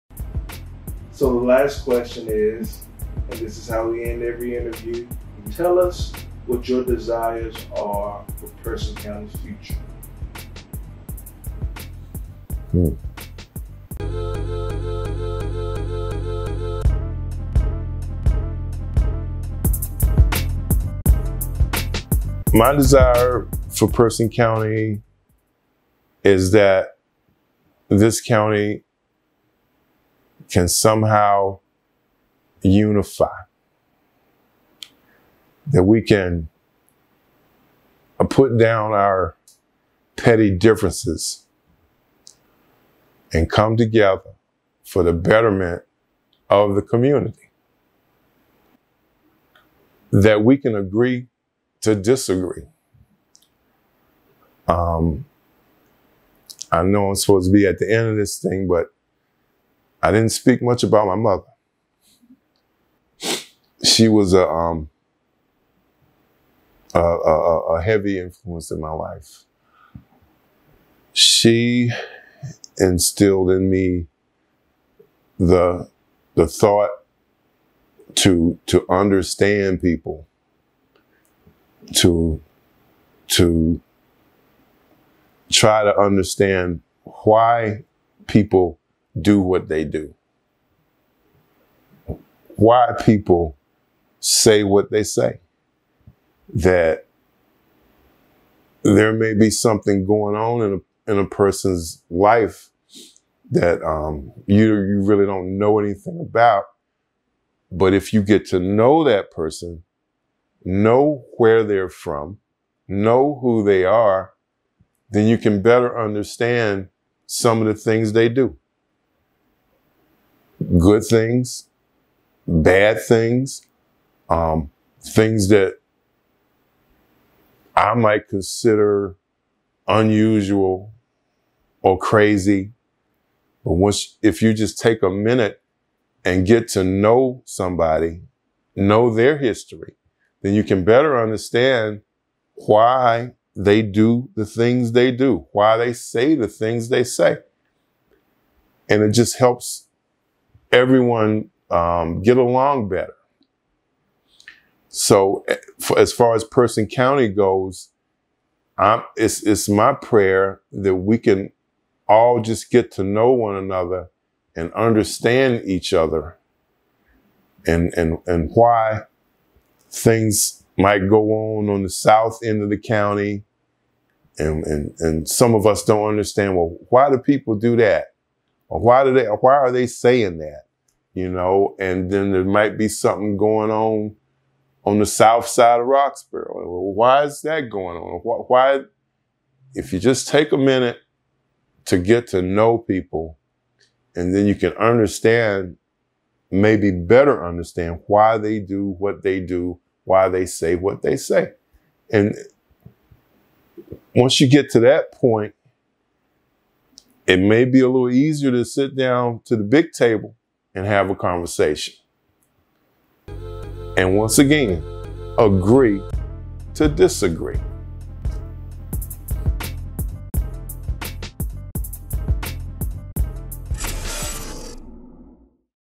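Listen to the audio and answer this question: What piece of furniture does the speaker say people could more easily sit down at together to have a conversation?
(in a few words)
The big table.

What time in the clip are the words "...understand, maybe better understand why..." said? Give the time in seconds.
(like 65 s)
194 s.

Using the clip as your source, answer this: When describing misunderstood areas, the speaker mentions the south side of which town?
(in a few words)
Roxboro.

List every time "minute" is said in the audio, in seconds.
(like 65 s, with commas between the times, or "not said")
135 s, 190 s.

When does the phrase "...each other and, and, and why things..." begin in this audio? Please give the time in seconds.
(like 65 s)
165 s.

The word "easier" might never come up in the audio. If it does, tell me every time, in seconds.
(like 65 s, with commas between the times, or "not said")
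208 s.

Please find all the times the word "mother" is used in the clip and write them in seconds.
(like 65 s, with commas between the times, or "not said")
61 s.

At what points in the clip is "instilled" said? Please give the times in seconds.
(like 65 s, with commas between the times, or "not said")
72 s.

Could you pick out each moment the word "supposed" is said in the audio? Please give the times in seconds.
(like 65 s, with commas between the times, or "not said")
57 s.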